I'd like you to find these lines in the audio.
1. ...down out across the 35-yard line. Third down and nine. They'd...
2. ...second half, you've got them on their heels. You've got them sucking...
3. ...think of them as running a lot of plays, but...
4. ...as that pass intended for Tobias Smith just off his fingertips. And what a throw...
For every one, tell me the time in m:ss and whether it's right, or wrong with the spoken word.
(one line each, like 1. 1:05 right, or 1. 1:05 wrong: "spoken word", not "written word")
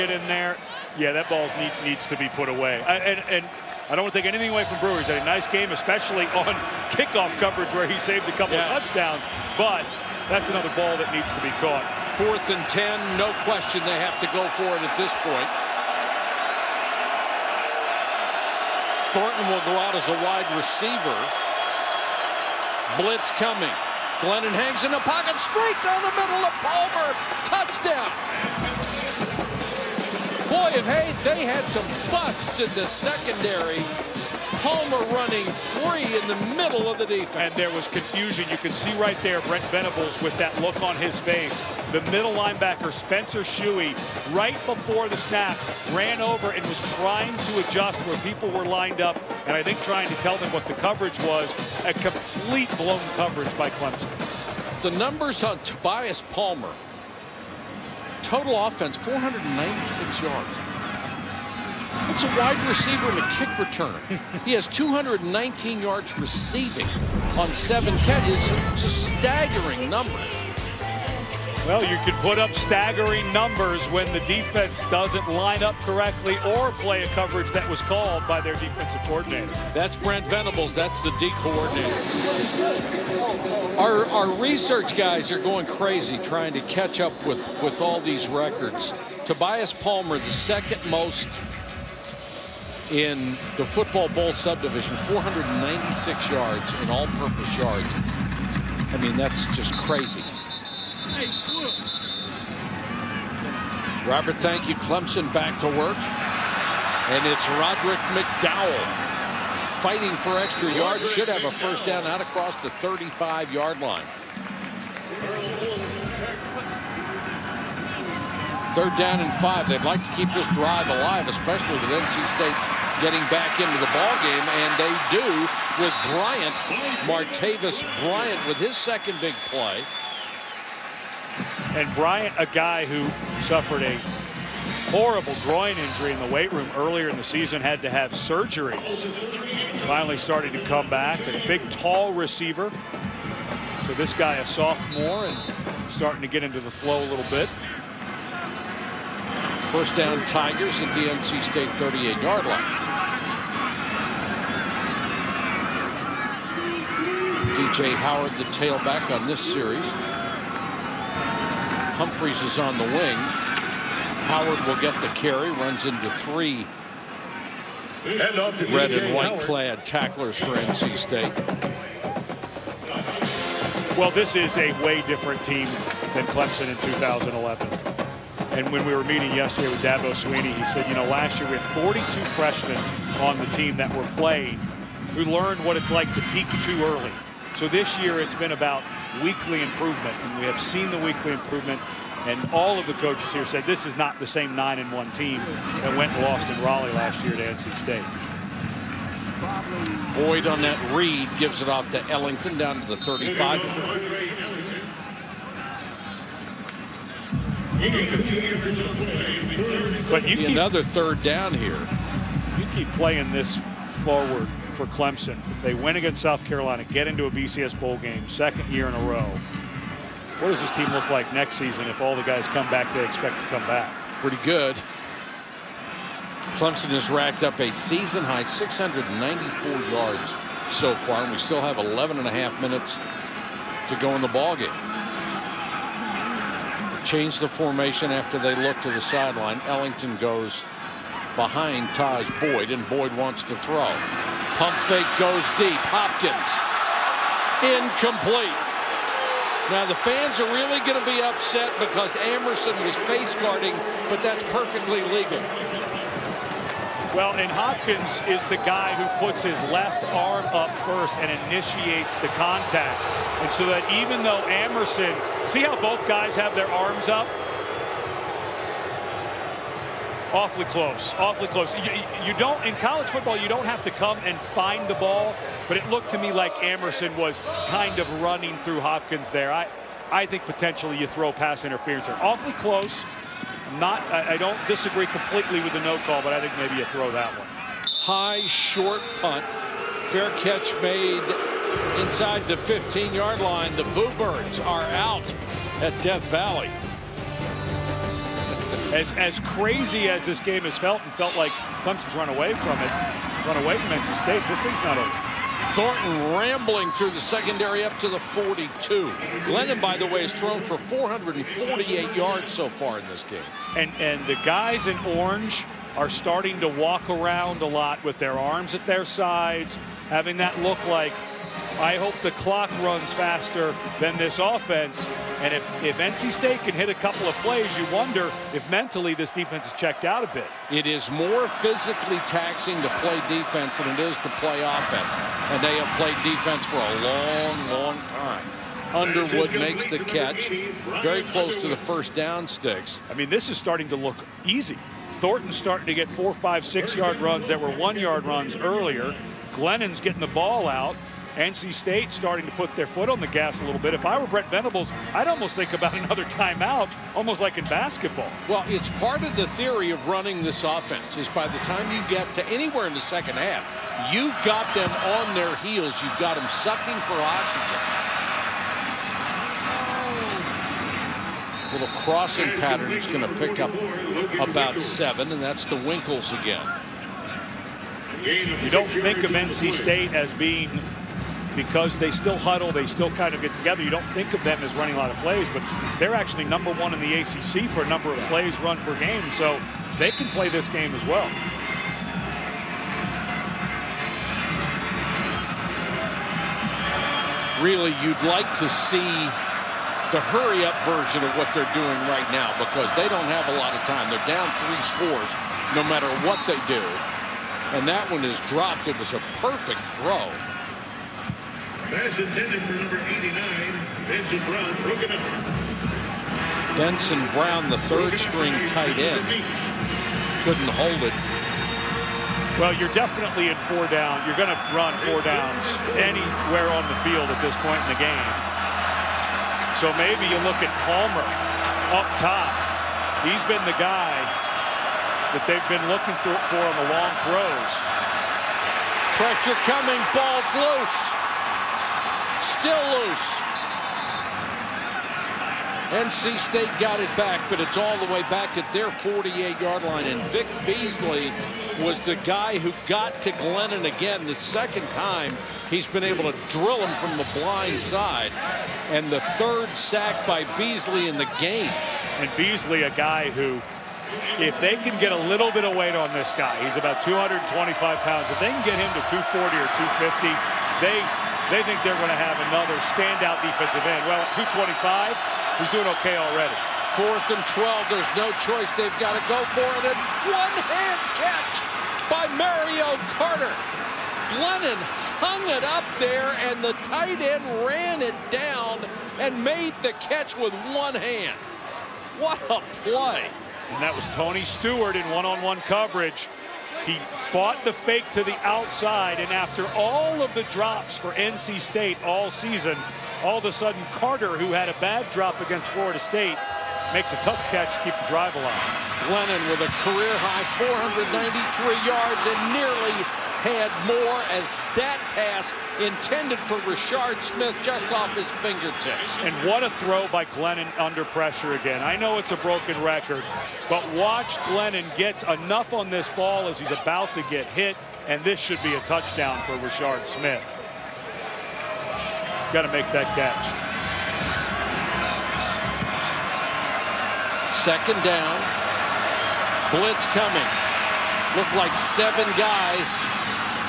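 1. 1:51 wrong: "five", not "nine"
2. 6:02 right
3. 6:24 right
4. 8:34 wrong: "Richard", not "Tobias".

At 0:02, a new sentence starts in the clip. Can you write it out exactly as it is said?
I, and, and I don't want to take anything away from Brewer.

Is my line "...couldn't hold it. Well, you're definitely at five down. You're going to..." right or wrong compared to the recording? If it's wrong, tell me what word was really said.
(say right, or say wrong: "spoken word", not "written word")
wrong: "four", not "five".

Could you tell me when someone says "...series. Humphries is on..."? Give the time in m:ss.
2:39.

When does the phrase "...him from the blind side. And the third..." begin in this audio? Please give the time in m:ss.
7:36.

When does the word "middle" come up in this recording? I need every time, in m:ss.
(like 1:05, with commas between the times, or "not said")
0:26, 0:36, 0:42.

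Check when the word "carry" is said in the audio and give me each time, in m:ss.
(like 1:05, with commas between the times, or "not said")
2:45.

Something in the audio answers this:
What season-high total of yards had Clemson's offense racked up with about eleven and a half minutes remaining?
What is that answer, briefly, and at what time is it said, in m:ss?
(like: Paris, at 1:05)
694, at 3:48.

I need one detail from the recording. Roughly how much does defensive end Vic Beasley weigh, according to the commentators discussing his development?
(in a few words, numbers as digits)
225 pounds.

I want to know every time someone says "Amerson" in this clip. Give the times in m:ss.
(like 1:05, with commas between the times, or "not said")
4:12, 4:24, 4:36.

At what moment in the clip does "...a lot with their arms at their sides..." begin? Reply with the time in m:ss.
5:17.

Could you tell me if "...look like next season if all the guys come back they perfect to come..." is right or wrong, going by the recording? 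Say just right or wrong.
wrong.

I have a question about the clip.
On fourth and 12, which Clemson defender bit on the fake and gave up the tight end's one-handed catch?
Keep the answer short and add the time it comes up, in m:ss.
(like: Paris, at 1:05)
Tony Stewart, at 8:14.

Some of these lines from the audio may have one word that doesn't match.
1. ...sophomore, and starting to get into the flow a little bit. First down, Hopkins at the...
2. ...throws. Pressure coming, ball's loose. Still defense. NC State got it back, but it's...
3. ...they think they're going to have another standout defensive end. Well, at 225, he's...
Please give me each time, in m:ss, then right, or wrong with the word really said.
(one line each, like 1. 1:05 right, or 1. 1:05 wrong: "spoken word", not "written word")
1. 2:24 wrong: "Tigers", not "Hopkins"
2. 7:17 wrong: "loose", not "defense"
3. 7:51 right.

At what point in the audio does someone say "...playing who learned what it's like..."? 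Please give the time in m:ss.
3:04.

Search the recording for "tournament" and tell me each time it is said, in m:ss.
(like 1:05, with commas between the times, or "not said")
not said.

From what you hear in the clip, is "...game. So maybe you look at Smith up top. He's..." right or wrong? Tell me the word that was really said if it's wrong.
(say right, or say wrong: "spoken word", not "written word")
wrong: "Palmer", not "Smith".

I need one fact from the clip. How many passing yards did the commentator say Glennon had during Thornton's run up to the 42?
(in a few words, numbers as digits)
448.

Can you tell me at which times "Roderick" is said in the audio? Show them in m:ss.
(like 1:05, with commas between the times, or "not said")
1:47.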